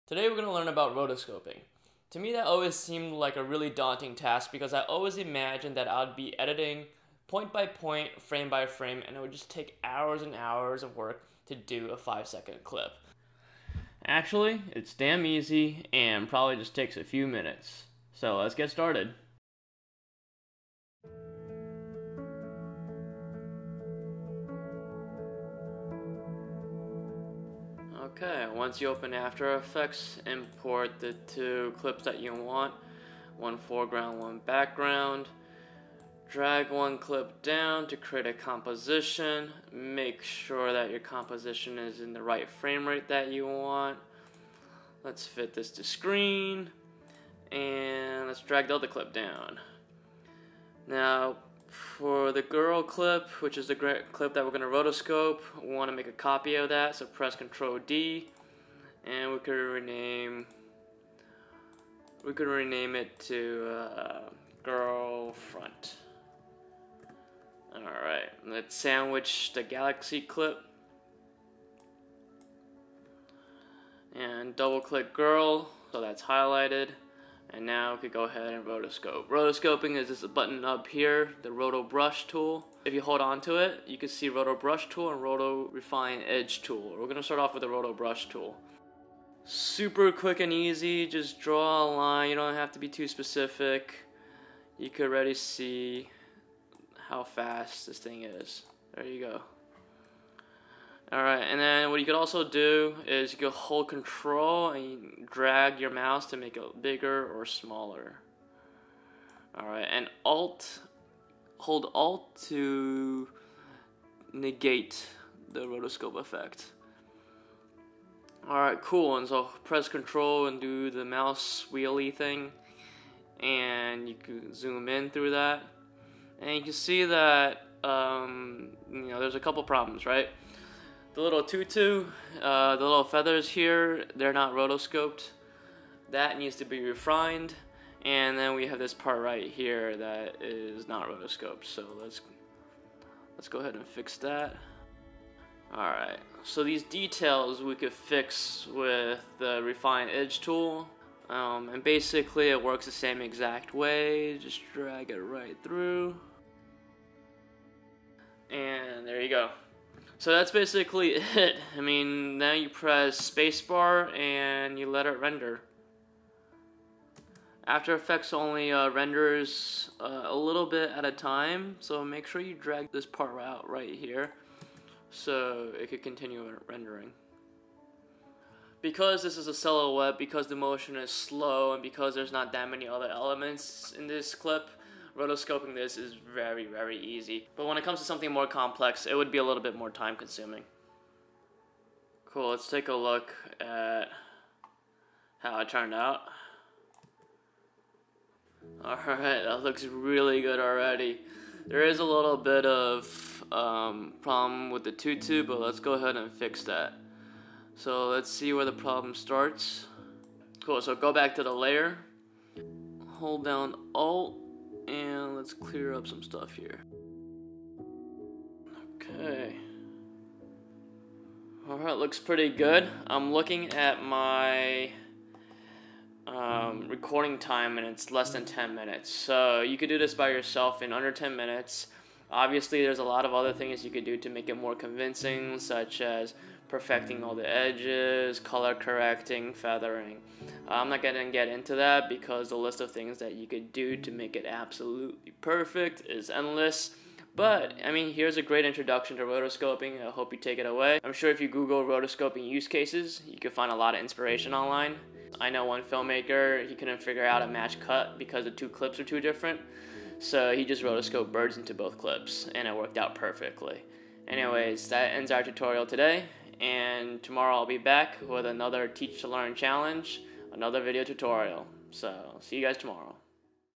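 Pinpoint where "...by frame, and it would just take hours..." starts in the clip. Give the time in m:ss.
0:08.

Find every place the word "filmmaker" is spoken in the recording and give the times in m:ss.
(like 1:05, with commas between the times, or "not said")
4:15.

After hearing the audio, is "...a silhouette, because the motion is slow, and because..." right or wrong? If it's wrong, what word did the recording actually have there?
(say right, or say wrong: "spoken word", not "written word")
right.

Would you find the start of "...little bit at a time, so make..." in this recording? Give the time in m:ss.
2:50.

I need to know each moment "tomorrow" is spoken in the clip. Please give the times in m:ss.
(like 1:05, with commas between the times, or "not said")
4:27, 4:32.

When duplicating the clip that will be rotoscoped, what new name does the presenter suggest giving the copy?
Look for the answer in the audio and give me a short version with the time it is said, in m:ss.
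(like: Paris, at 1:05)
girl front, at 1:04.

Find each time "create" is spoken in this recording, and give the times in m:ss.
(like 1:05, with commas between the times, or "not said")
0:37.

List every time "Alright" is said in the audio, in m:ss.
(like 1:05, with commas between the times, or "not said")
1:07, 2:25, 3:18, 3:41.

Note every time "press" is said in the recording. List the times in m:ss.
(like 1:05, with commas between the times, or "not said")
0:57, 1:59, 2:42.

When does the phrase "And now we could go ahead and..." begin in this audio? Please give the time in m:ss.
1:17.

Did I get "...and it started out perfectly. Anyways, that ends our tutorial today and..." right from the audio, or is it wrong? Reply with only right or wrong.
wrong.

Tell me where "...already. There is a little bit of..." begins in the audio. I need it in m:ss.
3:20.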